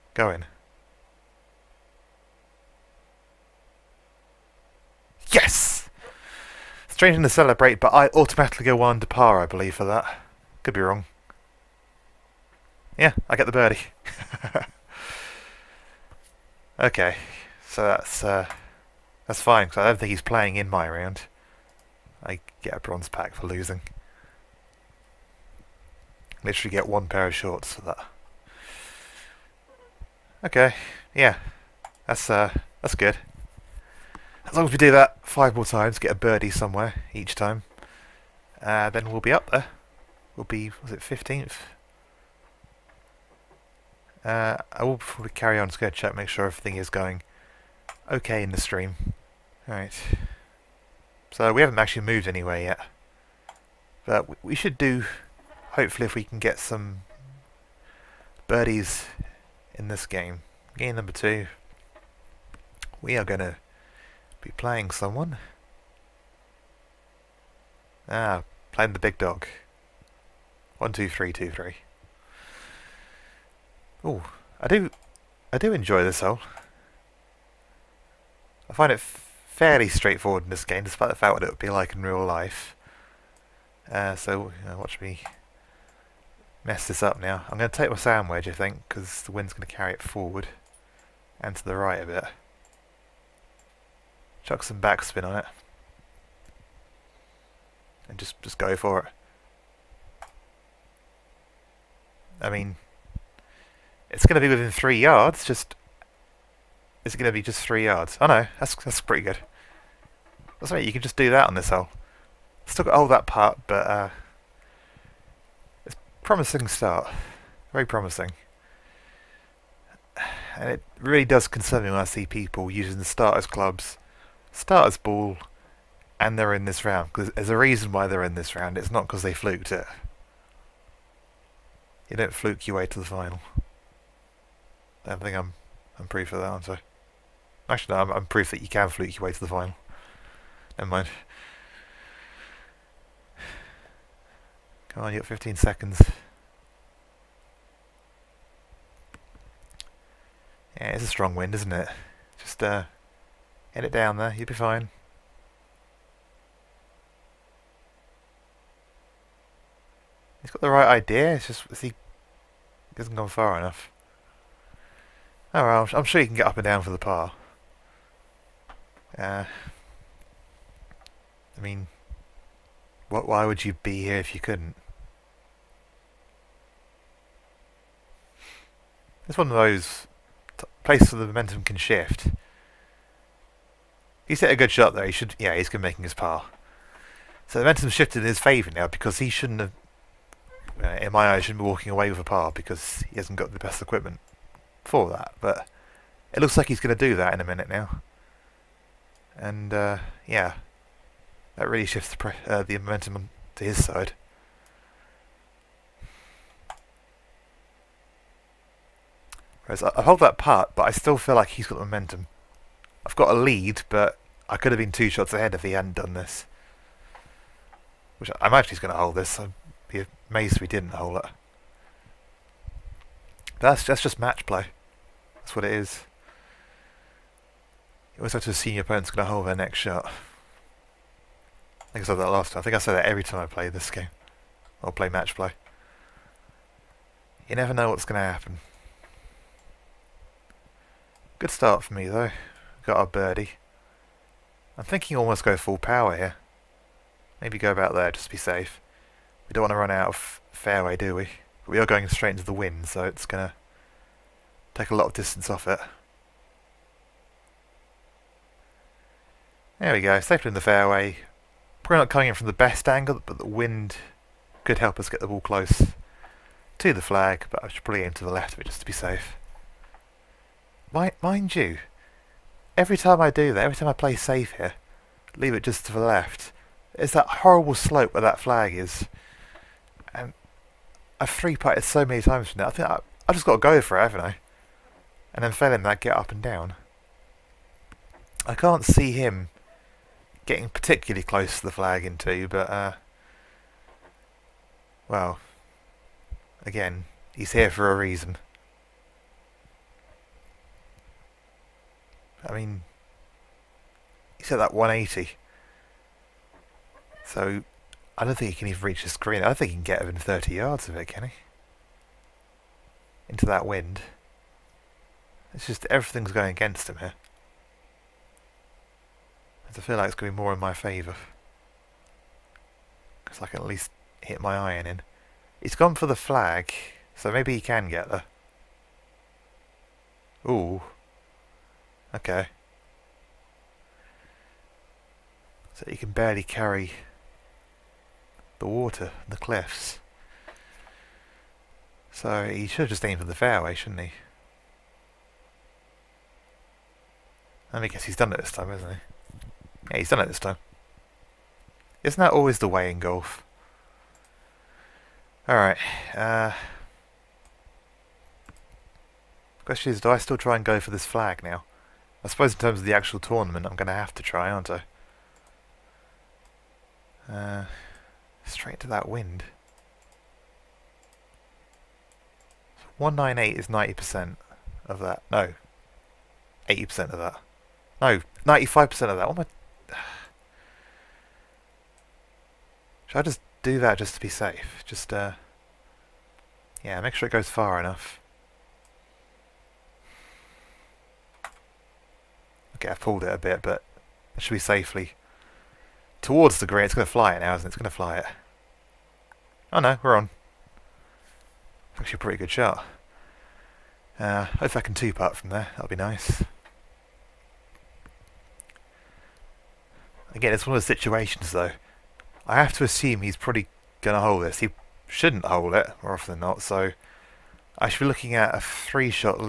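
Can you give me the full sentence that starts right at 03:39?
I'd be amazed if we didn't hold it.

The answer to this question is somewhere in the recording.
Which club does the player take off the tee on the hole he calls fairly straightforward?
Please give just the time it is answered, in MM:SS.
01:27.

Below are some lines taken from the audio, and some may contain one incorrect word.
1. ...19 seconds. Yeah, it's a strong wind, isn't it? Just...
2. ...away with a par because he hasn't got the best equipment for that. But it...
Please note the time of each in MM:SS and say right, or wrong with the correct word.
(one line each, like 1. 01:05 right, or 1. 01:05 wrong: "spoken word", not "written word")
1. 02:25 wrong: "15", not "19"
2. 03:11 right.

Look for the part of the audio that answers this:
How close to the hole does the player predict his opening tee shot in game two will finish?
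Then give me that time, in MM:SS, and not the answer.
01:44.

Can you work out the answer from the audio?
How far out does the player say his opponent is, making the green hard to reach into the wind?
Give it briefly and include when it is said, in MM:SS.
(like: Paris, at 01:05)
180, at 05:04.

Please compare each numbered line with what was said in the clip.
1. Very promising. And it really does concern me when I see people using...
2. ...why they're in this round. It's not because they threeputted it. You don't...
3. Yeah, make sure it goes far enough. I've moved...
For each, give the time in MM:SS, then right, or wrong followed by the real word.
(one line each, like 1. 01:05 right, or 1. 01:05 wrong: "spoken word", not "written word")
1. 01:57 right
2. 02:07 wrong: "fluked", not "threeputted"
3. 06:26 wrong: "pulled", not "moved".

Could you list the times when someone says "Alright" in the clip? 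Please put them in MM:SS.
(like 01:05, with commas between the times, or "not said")
00:49, 05:55.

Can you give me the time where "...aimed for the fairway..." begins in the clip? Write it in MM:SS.
05:43.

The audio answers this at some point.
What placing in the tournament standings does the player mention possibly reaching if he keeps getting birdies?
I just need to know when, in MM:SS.
00:40.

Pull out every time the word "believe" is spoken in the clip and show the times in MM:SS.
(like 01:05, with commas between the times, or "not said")
00:09.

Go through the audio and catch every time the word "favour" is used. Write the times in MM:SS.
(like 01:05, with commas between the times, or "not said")
03:08, 05:20.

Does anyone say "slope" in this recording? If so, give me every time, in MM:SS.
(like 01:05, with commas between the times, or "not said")
04:37.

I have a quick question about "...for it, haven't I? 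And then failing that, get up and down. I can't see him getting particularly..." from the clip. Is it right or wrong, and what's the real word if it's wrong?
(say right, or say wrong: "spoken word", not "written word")
right.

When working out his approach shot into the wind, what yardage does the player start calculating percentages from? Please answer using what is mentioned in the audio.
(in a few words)
198.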